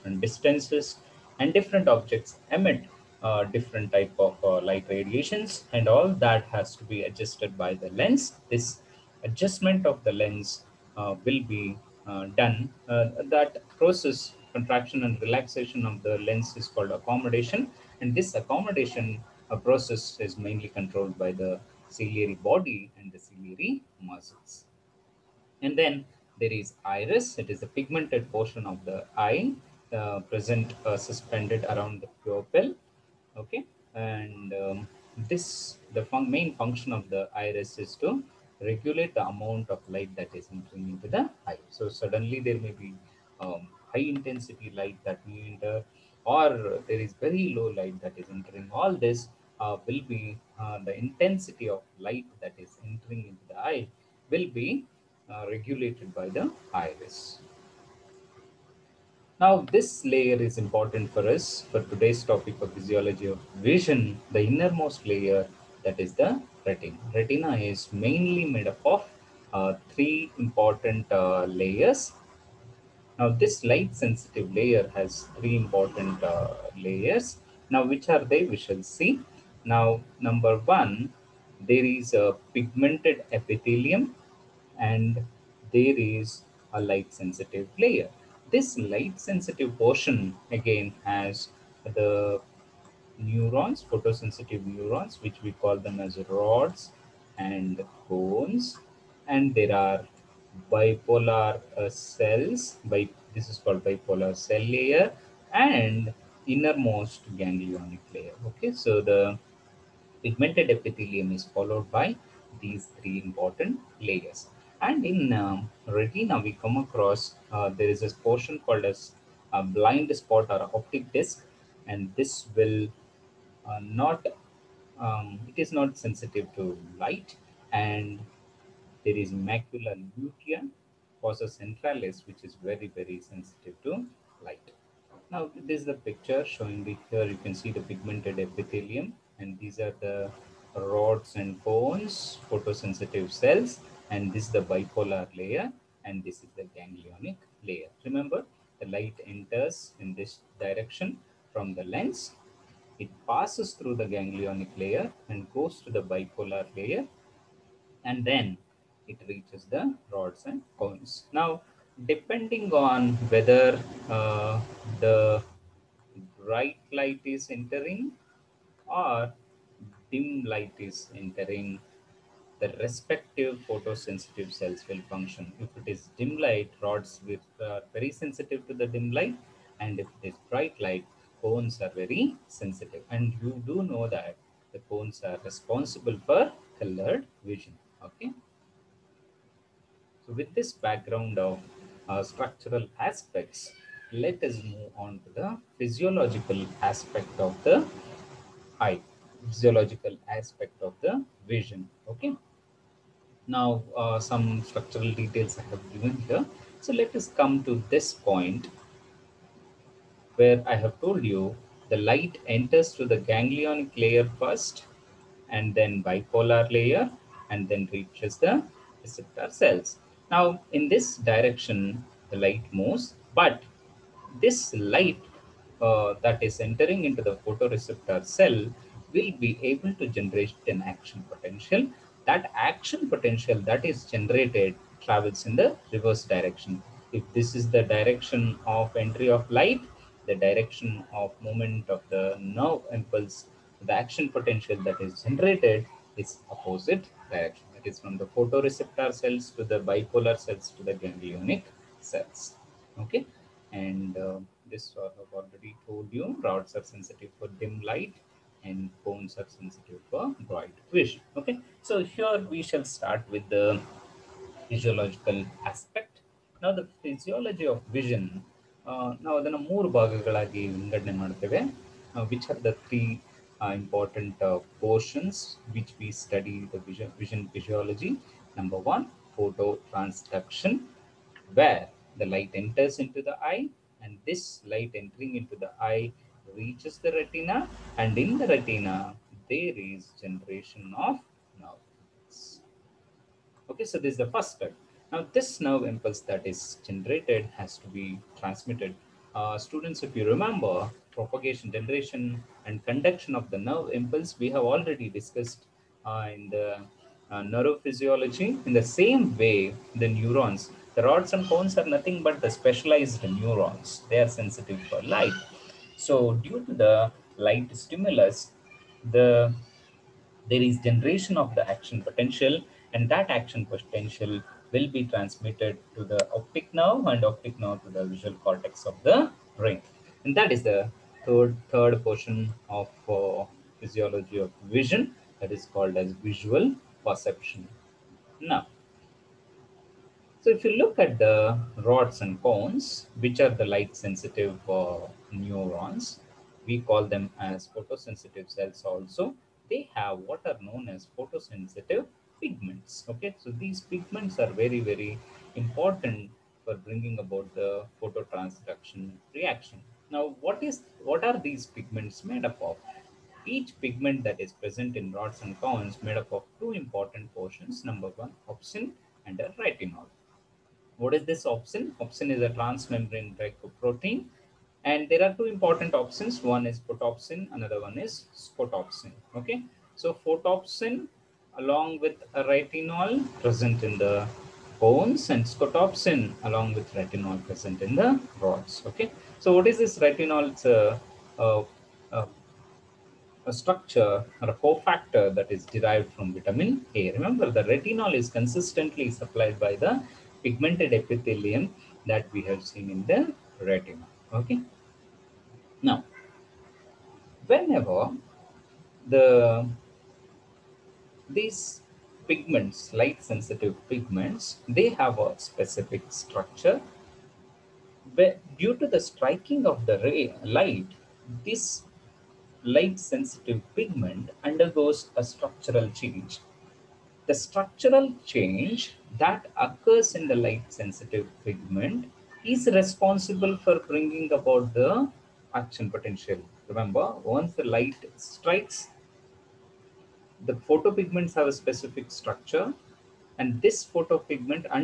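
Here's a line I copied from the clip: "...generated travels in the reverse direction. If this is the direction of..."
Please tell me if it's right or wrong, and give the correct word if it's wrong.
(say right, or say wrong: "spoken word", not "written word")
right.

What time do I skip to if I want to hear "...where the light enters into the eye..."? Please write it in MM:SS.
04:41.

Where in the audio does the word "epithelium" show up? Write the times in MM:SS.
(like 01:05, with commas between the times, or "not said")
01:23, 01:50, 02:18, 06:40.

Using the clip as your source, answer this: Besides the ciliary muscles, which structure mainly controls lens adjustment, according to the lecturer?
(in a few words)
ciliary body.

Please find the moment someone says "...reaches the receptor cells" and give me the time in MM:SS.
03:37.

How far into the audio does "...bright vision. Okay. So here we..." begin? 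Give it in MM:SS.
04:20.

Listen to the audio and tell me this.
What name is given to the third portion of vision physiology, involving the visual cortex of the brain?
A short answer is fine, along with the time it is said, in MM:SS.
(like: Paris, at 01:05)
visual perception, at 05:36.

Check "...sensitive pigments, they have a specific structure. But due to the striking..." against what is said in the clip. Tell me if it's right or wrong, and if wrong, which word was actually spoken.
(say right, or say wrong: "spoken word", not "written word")
right.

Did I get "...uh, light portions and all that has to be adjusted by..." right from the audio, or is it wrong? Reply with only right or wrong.
wrong.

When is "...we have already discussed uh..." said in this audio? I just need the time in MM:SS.
05:04.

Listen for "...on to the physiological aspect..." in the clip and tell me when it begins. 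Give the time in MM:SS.
03:14.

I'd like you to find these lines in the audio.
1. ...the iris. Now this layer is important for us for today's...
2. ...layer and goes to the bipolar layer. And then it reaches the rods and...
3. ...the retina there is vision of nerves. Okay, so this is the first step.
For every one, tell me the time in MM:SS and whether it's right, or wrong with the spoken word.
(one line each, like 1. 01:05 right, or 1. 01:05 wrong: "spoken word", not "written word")
1. 00:56 right
2. 02:34 right
3. 04:48 wrong: "generation", not "vision".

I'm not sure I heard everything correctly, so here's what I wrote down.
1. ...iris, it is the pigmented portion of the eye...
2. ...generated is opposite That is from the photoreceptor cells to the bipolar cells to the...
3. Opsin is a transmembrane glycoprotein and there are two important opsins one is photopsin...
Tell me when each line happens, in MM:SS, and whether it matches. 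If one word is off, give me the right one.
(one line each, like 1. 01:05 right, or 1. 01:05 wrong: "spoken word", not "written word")
1. 00:26 right
2. 04:05 right
3. 06:12 right.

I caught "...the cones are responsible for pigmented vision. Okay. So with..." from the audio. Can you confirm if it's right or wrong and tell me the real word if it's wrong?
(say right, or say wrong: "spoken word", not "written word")
wrong: "colored", not "pigmented".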